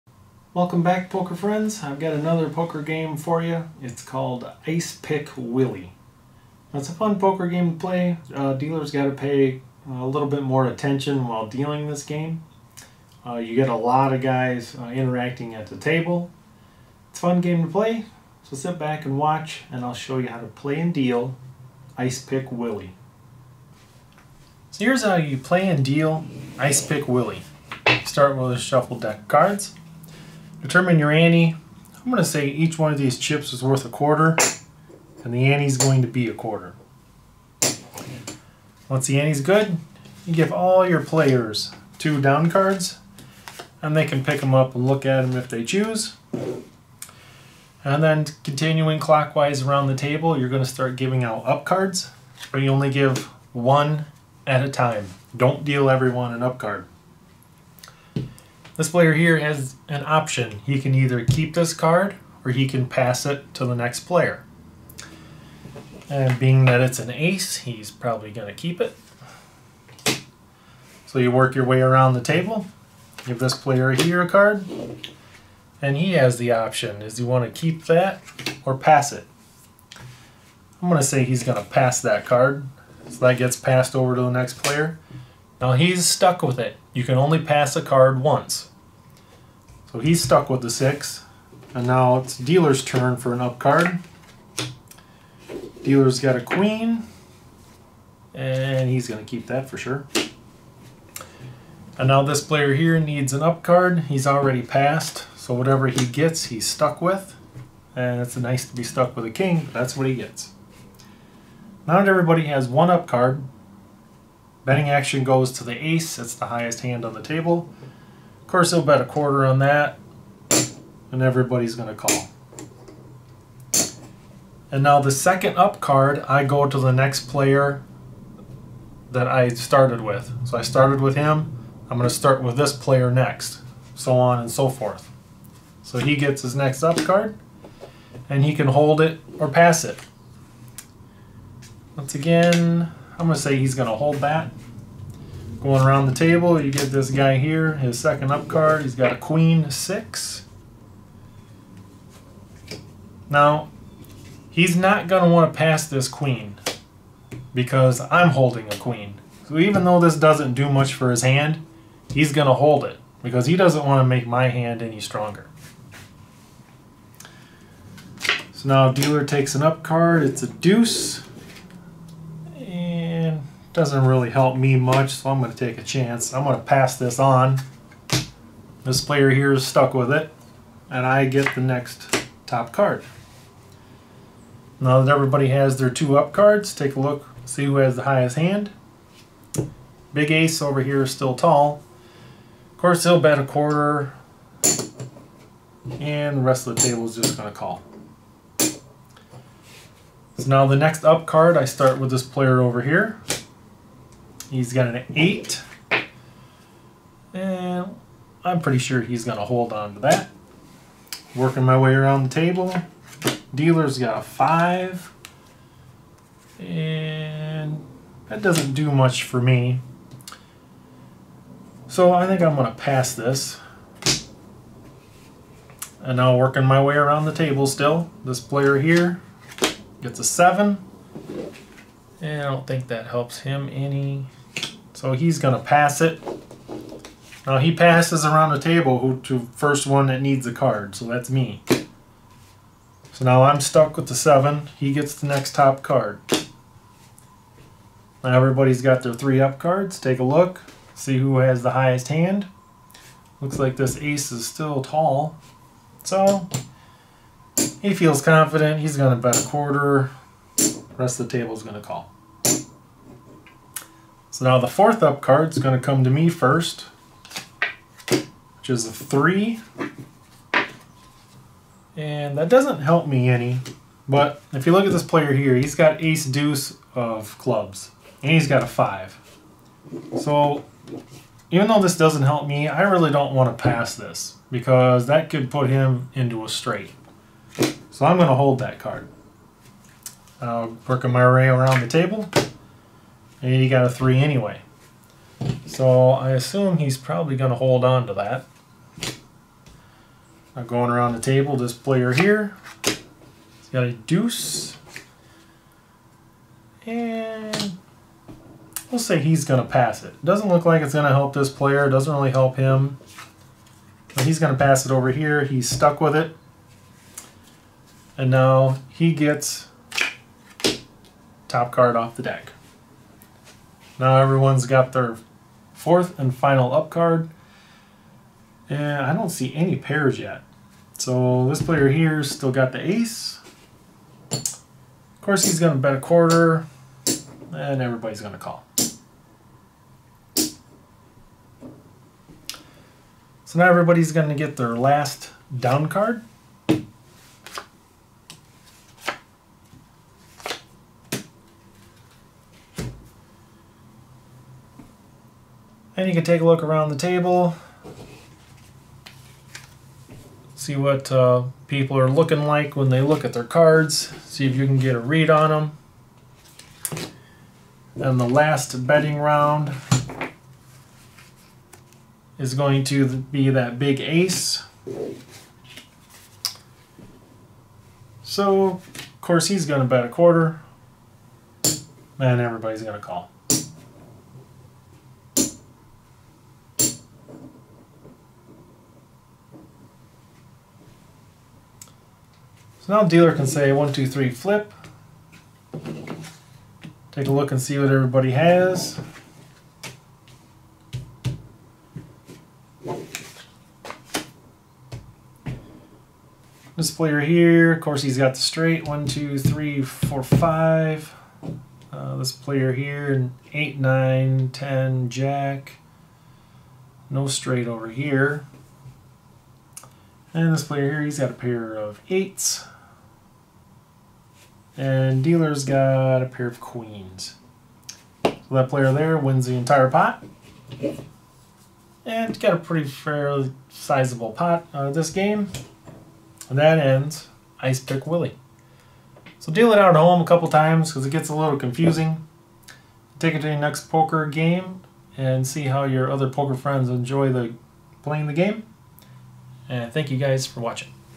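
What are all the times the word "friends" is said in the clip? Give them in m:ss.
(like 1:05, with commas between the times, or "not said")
0:01, 7:26.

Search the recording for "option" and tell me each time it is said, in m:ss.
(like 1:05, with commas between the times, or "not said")
1:00, 1:16.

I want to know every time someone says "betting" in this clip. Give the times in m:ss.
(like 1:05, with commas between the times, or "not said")
1:54, 6:08.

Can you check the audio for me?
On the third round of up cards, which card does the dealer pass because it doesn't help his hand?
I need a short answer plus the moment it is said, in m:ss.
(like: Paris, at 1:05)
5, at 3:33.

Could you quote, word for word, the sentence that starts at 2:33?
Now, he's not going to want to pass this queen because I'm holding a queen.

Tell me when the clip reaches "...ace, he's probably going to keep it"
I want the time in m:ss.
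1:07.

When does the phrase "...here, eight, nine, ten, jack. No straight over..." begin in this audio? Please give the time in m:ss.
6:52.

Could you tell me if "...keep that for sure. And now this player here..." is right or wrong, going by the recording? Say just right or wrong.
right.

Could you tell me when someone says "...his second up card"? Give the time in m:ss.
2:27.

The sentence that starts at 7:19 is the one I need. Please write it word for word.
So deal it out at home a couple times because it gets a little confusing.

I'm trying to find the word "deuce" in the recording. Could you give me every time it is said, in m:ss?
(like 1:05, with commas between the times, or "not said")
2:50, 4:36, 5:03.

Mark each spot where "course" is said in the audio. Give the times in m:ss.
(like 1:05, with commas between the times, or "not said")
1:58, 3:12, 5:35, 6:19, 6:47.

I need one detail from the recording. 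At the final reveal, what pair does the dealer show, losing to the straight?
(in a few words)
Pair of queens.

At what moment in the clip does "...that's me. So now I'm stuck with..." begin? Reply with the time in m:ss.
4:01.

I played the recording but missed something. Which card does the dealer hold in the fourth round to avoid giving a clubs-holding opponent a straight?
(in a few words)
3.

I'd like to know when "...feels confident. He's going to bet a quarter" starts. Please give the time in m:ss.
4:17.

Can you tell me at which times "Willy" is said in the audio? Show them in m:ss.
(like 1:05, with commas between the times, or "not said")
0:05, 0:22, 0:27, 7:18.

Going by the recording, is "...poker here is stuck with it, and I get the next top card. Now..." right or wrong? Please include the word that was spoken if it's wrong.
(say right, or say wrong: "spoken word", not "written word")
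wrong: "player", not "poker".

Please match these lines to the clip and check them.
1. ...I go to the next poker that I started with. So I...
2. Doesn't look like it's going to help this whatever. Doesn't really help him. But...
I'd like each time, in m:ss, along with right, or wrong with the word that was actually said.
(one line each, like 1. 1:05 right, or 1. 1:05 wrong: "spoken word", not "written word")
1. 2:06 wrong: "player", not "poker"
2. 5:10 wrong: "player", not "whatever".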